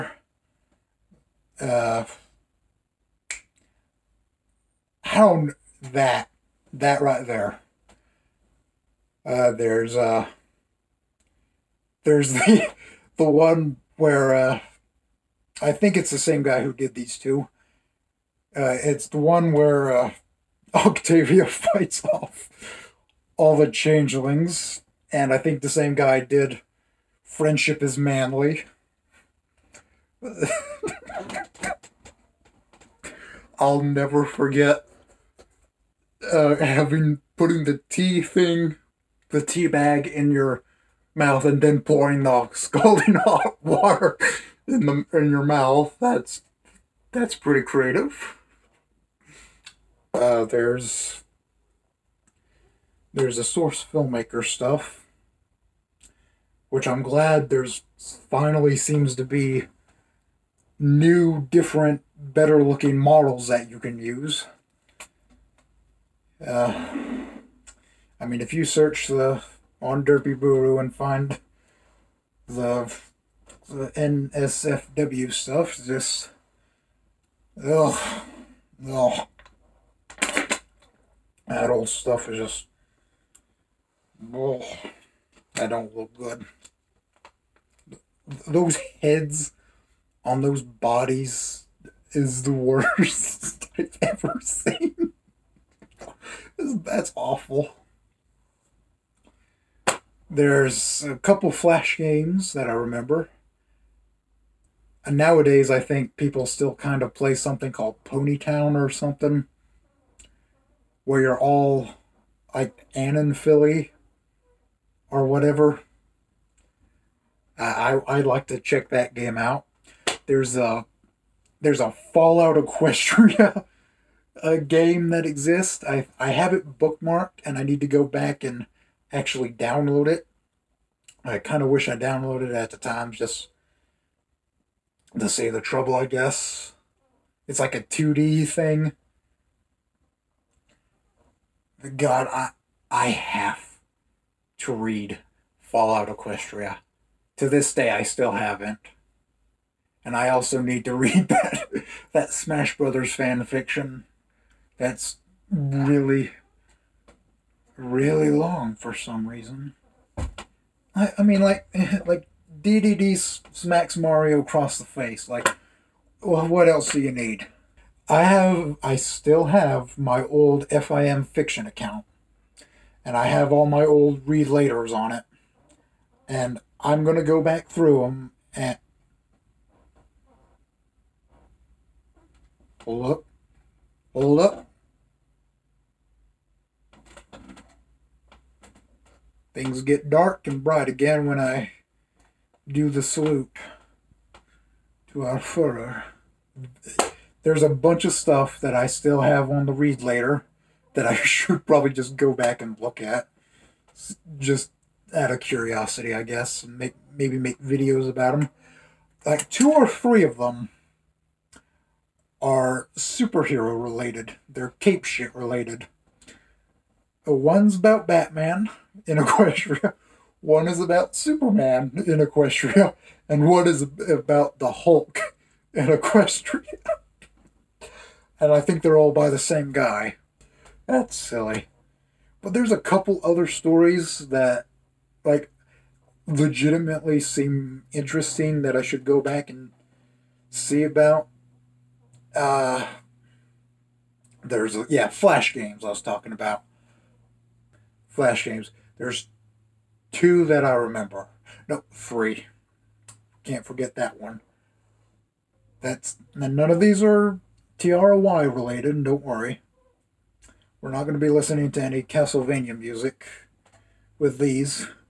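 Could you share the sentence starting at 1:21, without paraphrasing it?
That old stuff is just, oh, that don't look good.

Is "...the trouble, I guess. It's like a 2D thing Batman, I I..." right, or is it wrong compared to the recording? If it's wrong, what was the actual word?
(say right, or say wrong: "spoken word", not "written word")
wrong: "God", not "Batman".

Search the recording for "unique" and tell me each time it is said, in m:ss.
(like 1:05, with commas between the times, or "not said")
not said.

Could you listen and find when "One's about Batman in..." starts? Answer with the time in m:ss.
3:37.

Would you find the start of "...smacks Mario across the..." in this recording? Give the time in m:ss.
2:43.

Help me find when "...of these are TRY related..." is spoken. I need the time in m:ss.
4:16.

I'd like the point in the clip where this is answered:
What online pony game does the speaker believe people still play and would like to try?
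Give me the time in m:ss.
1:48.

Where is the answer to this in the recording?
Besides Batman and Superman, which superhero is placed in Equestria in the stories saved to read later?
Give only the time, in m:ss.
3:44.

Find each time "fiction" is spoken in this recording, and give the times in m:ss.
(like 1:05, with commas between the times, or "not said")
2:33, 2:51.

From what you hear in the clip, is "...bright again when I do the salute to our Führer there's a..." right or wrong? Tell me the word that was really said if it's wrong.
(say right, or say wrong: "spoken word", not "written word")
right.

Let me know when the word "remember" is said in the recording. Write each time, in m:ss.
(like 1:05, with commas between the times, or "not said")
1:42, 4:10.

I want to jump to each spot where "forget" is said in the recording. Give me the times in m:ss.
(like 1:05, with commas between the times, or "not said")
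0:34, 4:13.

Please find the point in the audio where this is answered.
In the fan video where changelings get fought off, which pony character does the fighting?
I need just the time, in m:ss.
0:20.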